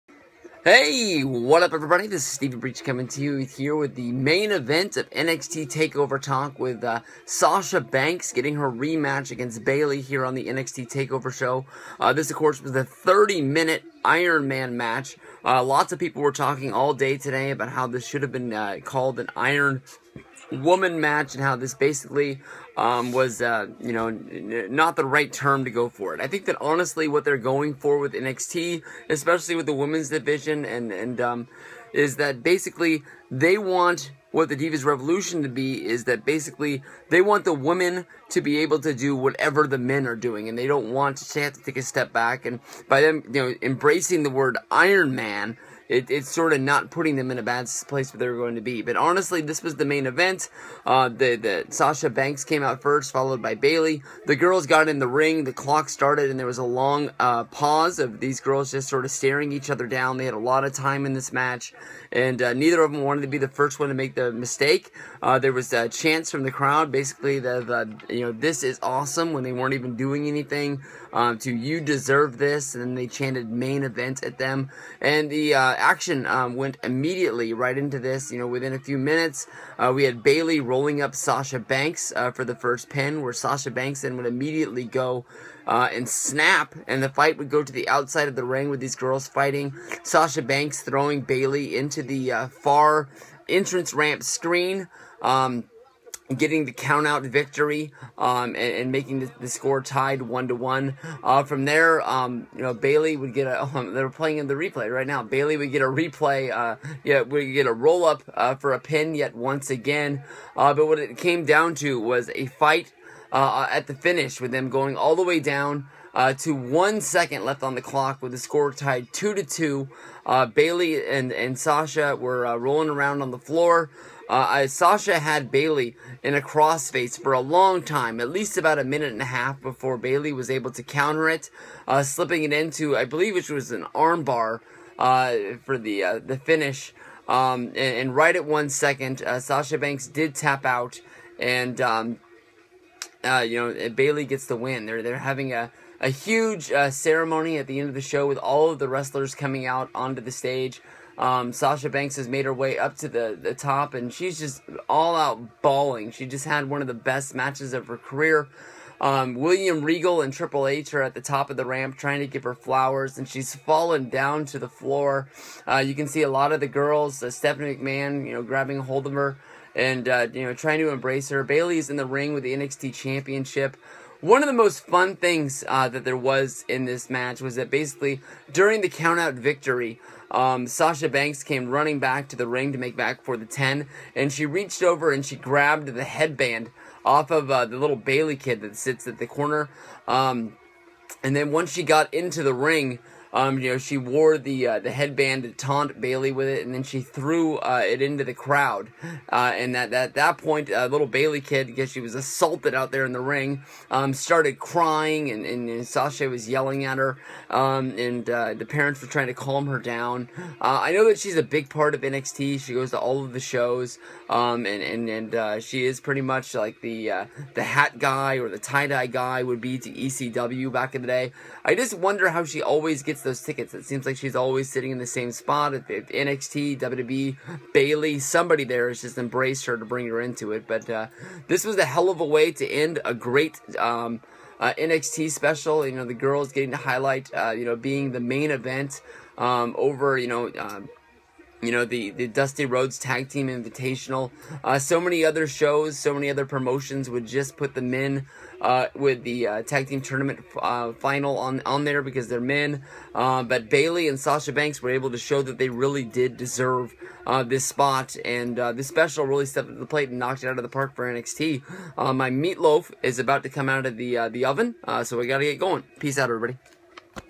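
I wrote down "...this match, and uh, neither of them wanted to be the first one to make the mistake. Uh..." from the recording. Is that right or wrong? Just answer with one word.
right.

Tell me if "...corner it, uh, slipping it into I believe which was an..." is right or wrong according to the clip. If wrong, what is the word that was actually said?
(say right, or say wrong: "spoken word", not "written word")
wrong: "counter", not "corner".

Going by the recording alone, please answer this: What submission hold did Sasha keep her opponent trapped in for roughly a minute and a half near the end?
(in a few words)
Crossface.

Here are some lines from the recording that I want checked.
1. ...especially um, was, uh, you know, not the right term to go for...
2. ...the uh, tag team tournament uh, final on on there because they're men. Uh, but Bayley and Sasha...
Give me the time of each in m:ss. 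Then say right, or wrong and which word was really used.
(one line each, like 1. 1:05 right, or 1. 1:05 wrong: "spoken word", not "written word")
1. 0:21 wrong: "basically", not "especially"
2. 4:09 right.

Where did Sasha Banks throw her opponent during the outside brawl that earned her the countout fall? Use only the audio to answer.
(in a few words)
Entrance ramp screen.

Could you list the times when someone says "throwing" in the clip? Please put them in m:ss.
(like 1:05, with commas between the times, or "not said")
1:30.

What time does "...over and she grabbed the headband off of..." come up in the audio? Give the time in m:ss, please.
3:04.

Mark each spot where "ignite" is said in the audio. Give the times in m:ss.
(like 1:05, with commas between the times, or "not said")
not said.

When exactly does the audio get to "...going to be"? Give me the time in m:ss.
0:48.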